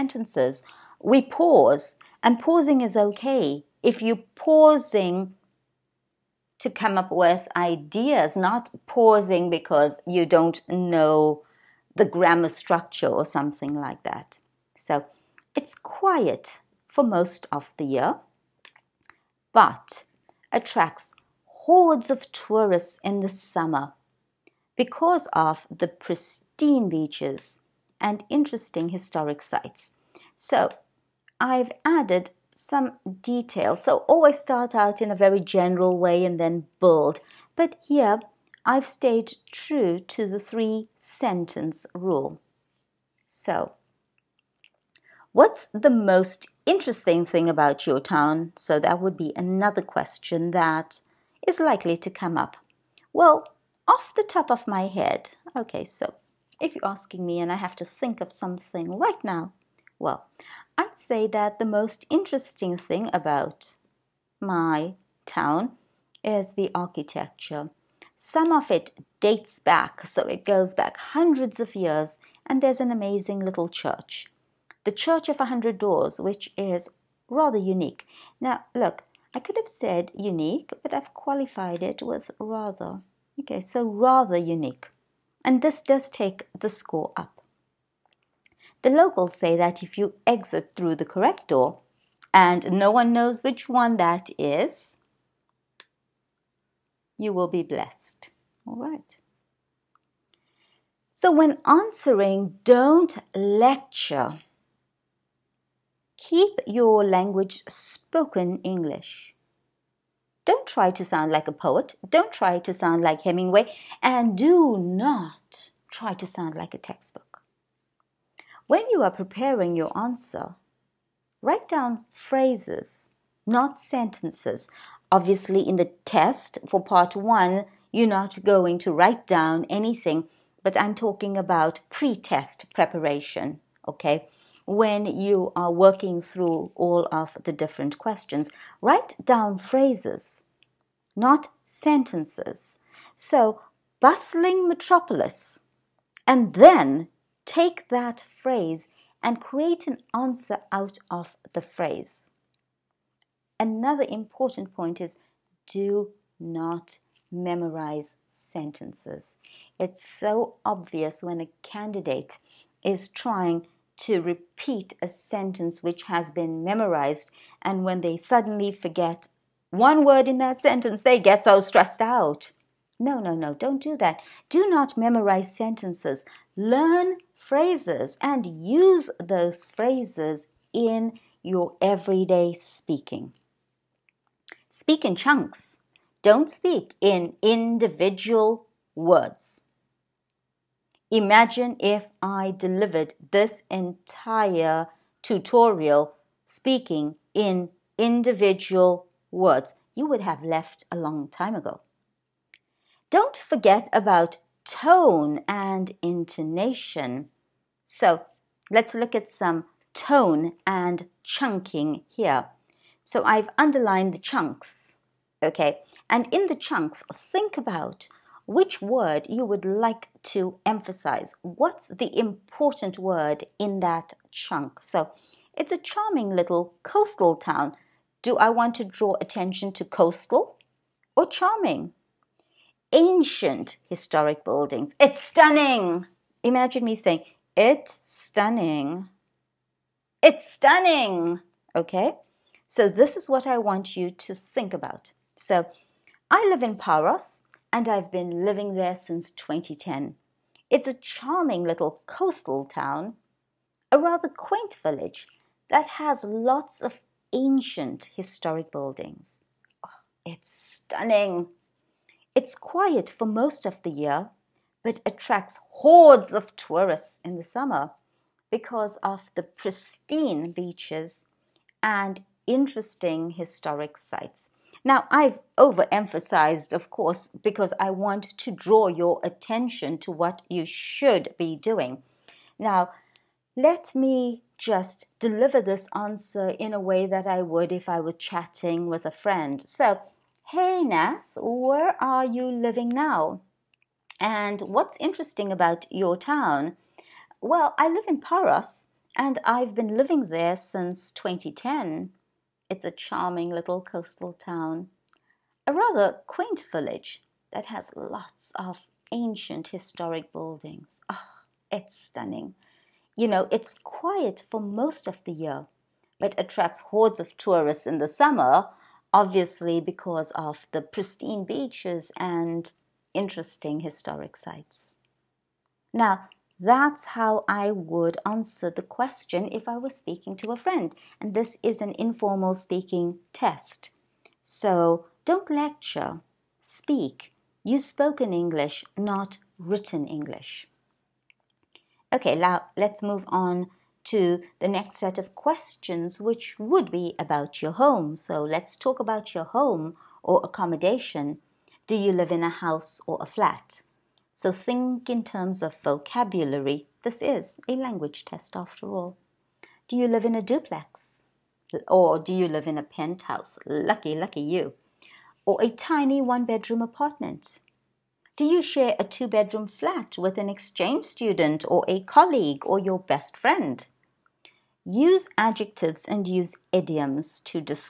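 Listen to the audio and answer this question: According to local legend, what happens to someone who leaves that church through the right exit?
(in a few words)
you will be blessed.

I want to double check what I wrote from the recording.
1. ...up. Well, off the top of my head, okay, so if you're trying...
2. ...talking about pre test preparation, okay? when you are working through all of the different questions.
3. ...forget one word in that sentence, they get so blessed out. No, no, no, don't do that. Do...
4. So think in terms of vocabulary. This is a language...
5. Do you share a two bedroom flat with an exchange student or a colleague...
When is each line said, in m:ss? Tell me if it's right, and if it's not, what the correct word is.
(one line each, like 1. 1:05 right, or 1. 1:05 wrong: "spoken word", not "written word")
1. 0:52 wrong: "asking", not "trying"
2. 2:10 right
3. 2:48 wrong: "stressed", not "blessed"
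4. 5:54 right
5. 6:08 right.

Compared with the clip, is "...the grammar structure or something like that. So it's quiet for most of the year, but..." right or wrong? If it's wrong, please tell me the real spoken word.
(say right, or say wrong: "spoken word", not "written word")
right.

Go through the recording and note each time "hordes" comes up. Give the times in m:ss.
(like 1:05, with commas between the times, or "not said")
0:21, 4:25, 5:16.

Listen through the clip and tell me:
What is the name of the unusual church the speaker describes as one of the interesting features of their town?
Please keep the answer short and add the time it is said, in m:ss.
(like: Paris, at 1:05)
Church of a Hundred Doors, at 1:14.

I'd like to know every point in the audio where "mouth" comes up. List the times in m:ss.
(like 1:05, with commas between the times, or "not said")
not said.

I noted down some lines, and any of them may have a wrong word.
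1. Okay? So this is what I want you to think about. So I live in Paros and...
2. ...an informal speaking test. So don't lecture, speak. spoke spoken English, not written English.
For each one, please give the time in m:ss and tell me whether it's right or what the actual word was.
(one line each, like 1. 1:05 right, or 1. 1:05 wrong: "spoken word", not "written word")
1. 4:01 right
2. 5:31 right.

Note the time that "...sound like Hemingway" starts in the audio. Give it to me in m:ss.
1:52.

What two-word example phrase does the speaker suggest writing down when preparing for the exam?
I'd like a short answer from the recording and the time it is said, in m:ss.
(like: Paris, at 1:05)
bustling metropolis, at 2:24.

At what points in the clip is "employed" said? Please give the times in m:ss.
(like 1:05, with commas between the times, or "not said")
not said.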